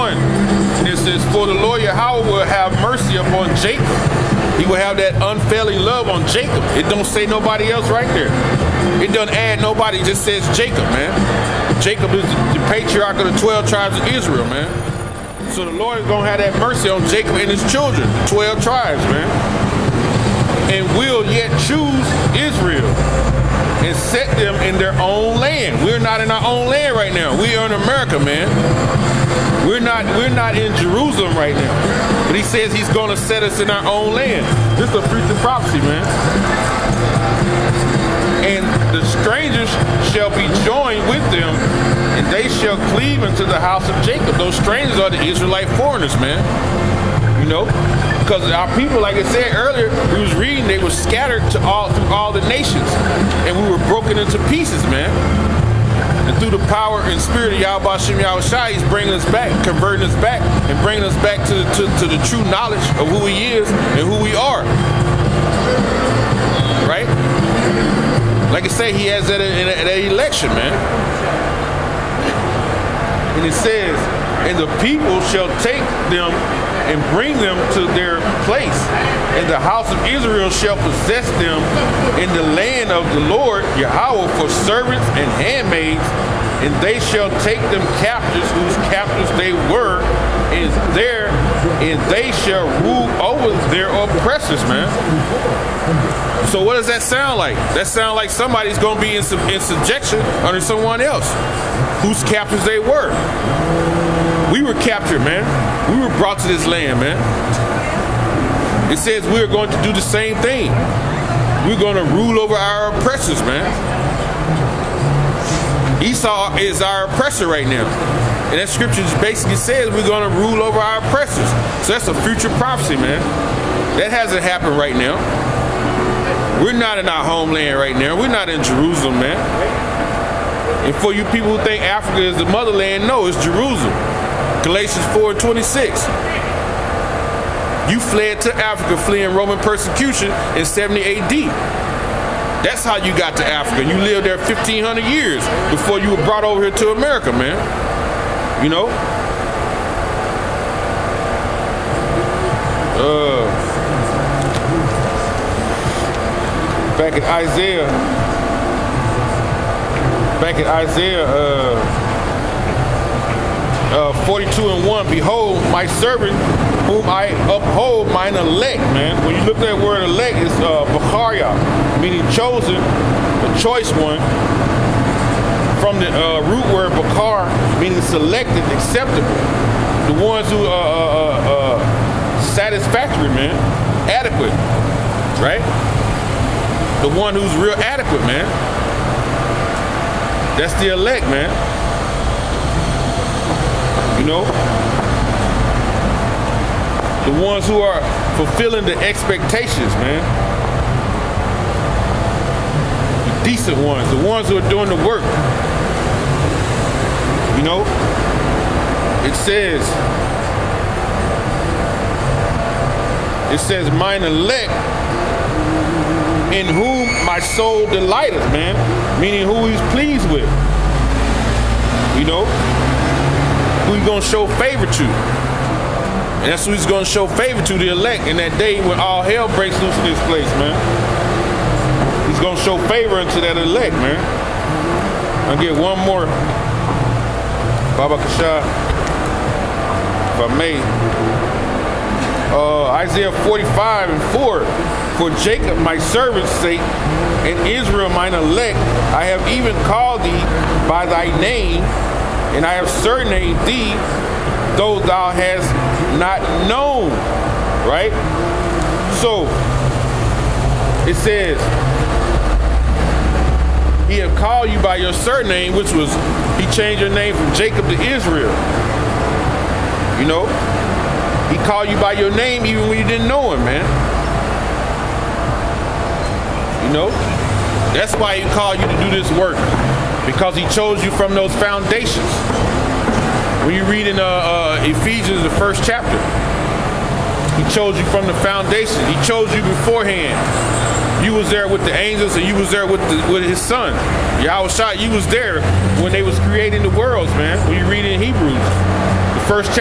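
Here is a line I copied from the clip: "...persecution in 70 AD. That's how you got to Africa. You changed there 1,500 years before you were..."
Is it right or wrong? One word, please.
wrong.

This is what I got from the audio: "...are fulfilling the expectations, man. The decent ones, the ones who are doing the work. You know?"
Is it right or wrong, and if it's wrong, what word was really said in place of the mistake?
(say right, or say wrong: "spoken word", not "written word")
right.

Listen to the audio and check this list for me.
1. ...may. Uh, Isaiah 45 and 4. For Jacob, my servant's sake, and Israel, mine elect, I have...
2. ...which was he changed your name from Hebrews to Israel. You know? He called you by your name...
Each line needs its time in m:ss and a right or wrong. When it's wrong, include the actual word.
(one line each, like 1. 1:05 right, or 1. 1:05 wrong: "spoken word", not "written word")
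1. 4:00 right
2. 4:25 wrong: "Jacob", not "Hebrews".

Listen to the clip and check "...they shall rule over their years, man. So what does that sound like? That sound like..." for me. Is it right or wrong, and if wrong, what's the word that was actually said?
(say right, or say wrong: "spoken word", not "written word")
wrong: "oppressors", not "years".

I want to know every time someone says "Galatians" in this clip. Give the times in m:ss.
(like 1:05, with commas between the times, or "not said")
2:14.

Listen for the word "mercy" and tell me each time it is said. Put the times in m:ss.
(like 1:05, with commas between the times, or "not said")
0:02, 0:16.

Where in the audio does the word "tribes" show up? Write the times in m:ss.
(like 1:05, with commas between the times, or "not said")
0:13, 0:18.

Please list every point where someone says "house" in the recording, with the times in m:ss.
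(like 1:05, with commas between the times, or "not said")
0:43, 1:19.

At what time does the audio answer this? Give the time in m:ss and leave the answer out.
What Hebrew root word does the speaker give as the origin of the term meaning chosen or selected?
2:56.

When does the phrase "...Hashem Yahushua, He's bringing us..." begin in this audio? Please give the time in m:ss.
0:57.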